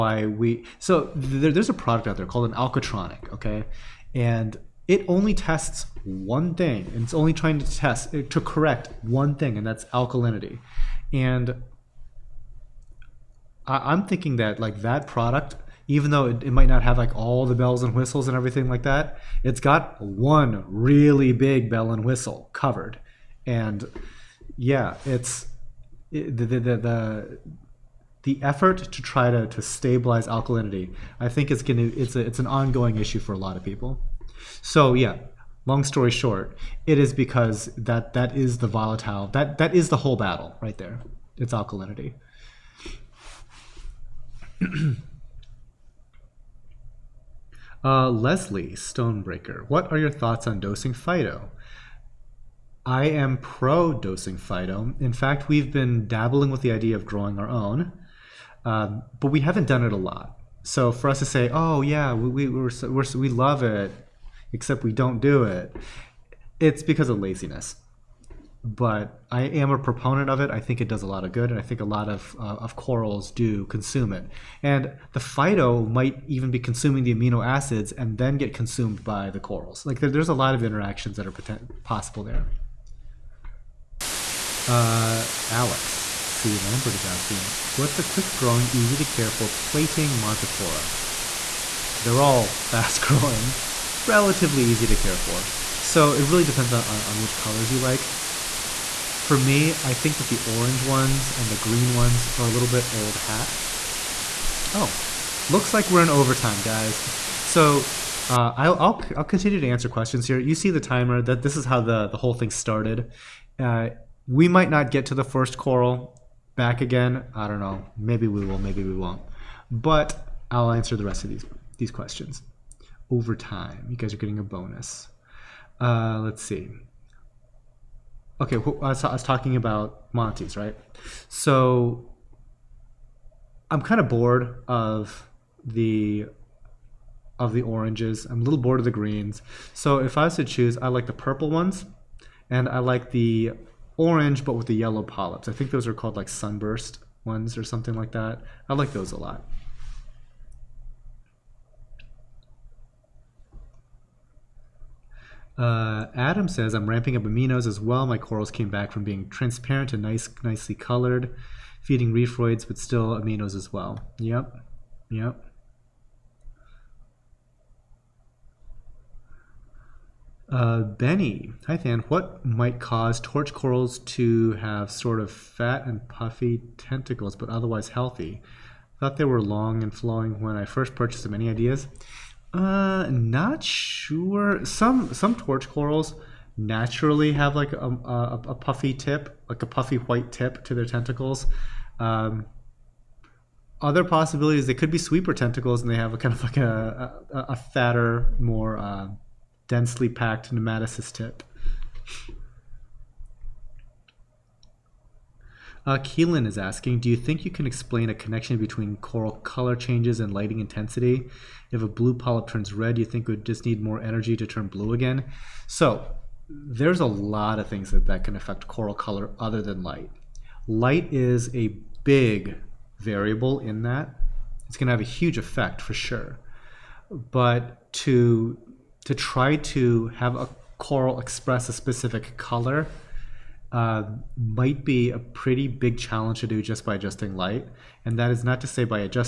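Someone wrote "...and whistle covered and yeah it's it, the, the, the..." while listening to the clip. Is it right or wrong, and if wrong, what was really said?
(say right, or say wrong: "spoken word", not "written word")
right.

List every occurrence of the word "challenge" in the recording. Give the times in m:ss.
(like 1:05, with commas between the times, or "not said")
3:55.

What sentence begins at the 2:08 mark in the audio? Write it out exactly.
Okay, I was, talking about Monty's, right?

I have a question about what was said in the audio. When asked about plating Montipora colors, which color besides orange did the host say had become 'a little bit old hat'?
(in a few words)
Green.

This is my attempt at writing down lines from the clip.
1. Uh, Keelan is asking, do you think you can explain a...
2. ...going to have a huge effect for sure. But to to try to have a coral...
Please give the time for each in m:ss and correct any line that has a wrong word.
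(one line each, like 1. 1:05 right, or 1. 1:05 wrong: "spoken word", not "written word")
1. 3:25 right
2. 3:44 right.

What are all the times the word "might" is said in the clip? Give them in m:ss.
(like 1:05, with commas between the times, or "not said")
0:16, 1:15, 1:54, 2:52, 3:54.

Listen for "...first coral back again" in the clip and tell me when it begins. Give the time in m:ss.
1:55.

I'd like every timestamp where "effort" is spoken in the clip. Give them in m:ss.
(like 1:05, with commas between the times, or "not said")
0:28.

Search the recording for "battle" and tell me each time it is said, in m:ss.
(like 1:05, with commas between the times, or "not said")
0:40.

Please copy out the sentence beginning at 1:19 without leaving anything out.
Like there, there's a lot of interactions that are potent, possible there.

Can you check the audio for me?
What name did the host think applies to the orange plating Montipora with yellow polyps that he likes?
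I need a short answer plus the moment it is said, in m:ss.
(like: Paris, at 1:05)
Sunburst, at 2:26.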